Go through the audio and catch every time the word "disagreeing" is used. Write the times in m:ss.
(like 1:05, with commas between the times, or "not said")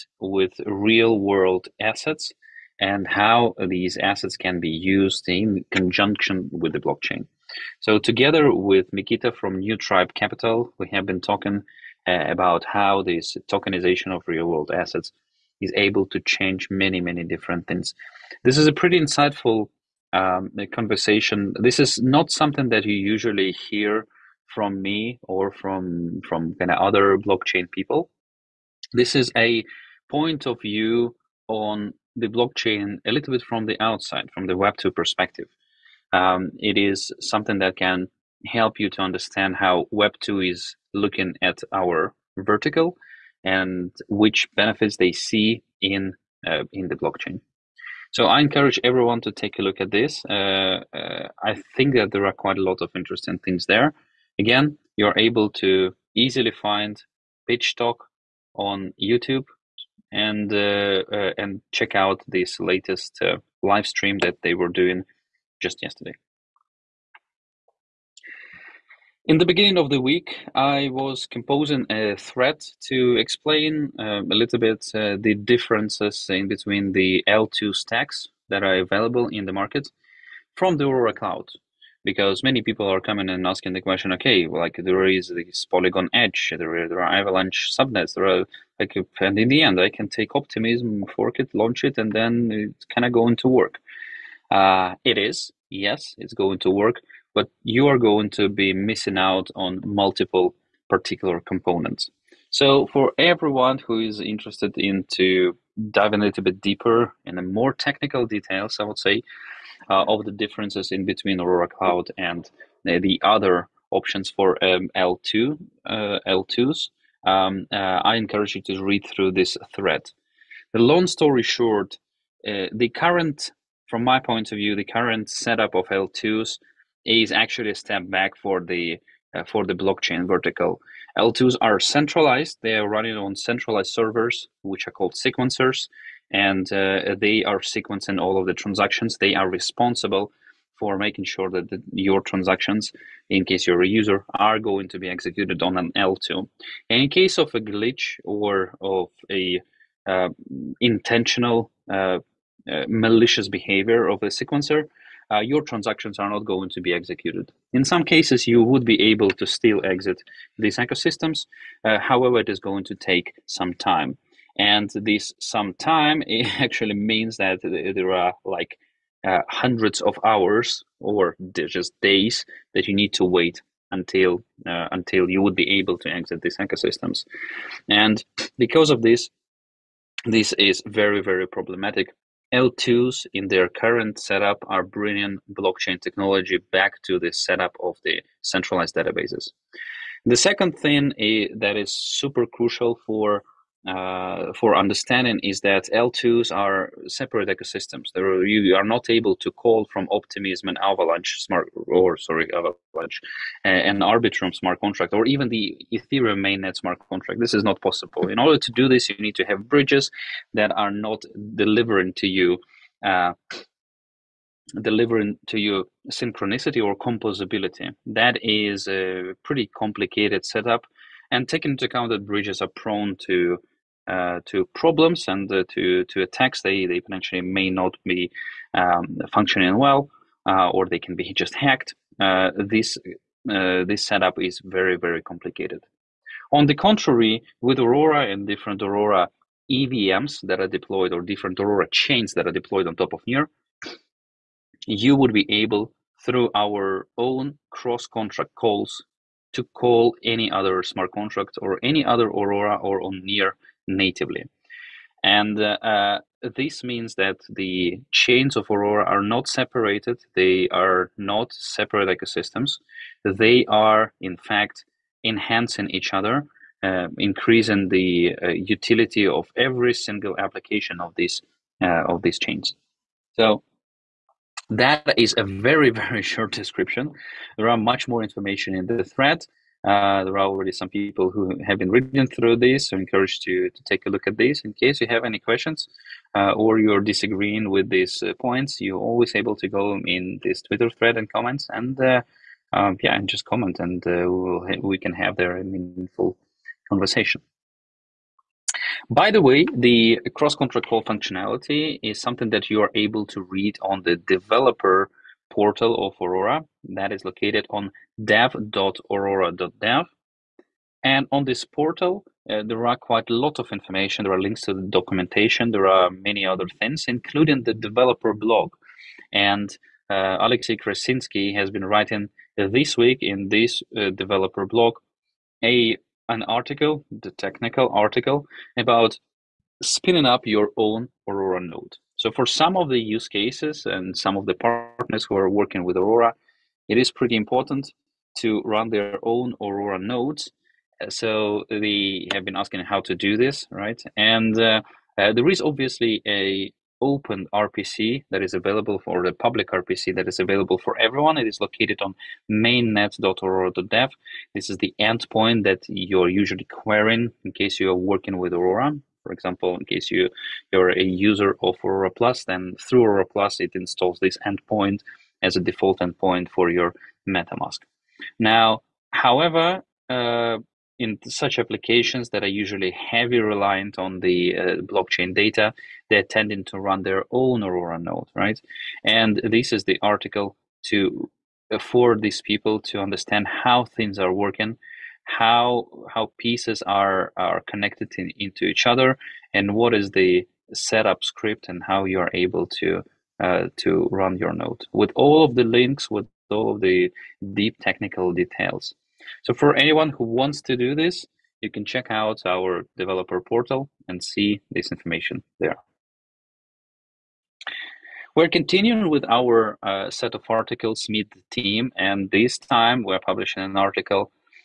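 4:46.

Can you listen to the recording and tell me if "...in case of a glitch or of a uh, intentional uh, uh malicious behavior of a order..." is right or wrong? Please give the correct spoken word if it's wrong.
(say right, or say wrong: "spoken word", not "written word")
wrong: "sequencer", not "order".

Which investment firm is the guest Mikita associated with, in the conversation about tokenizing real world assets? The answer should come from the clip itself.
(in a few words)
New Tribe Capital.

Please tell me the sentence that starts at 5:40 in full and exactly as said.
Uh, so they have been asking how to do this, right?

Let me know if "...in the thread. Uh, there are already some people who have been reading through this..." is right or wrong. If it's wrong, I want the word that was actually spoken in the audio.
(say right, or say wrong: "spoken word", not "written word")
right.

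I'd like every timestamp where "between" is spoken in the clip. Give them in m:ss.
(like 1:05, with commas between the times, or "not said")
1:16, 1:51.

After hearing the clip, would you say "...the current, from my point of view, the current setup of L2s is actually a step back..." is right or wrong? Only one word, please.
right.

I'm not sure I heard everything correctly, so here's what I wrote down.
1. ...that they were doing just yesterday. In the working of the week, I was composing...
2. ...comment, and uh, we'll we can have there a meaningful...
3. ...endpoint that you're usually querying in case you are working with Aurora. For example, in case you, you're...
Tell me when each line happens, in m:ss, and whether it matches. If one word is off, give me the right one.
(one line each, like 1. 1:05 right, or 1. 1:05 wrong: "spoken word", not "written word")
1. 1:04 wrong: "beginning", not "working"
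2. 4:53 right
3. 5:54 right.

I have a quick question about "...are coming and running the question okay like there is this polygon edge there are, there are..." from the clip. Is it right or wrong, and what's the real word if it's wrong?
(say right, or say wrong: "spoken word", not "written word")
wrong: "asking", not "running".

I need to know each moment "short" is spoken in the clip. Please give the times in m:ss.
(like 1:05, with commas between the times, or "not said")
2:01, 4:36.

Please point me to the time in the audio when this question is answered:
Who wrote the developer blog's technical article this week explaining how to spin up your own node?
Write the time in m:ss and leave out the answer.
5:20.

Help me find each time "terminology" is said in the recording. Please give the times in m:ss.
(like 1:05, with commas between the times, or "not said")
not said.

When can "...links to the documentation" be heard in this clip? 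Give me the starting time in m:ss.
5:14.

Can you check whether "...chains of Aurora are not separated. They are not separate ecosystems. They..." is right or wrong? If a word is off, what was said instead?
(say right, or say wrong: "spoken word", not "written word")
right.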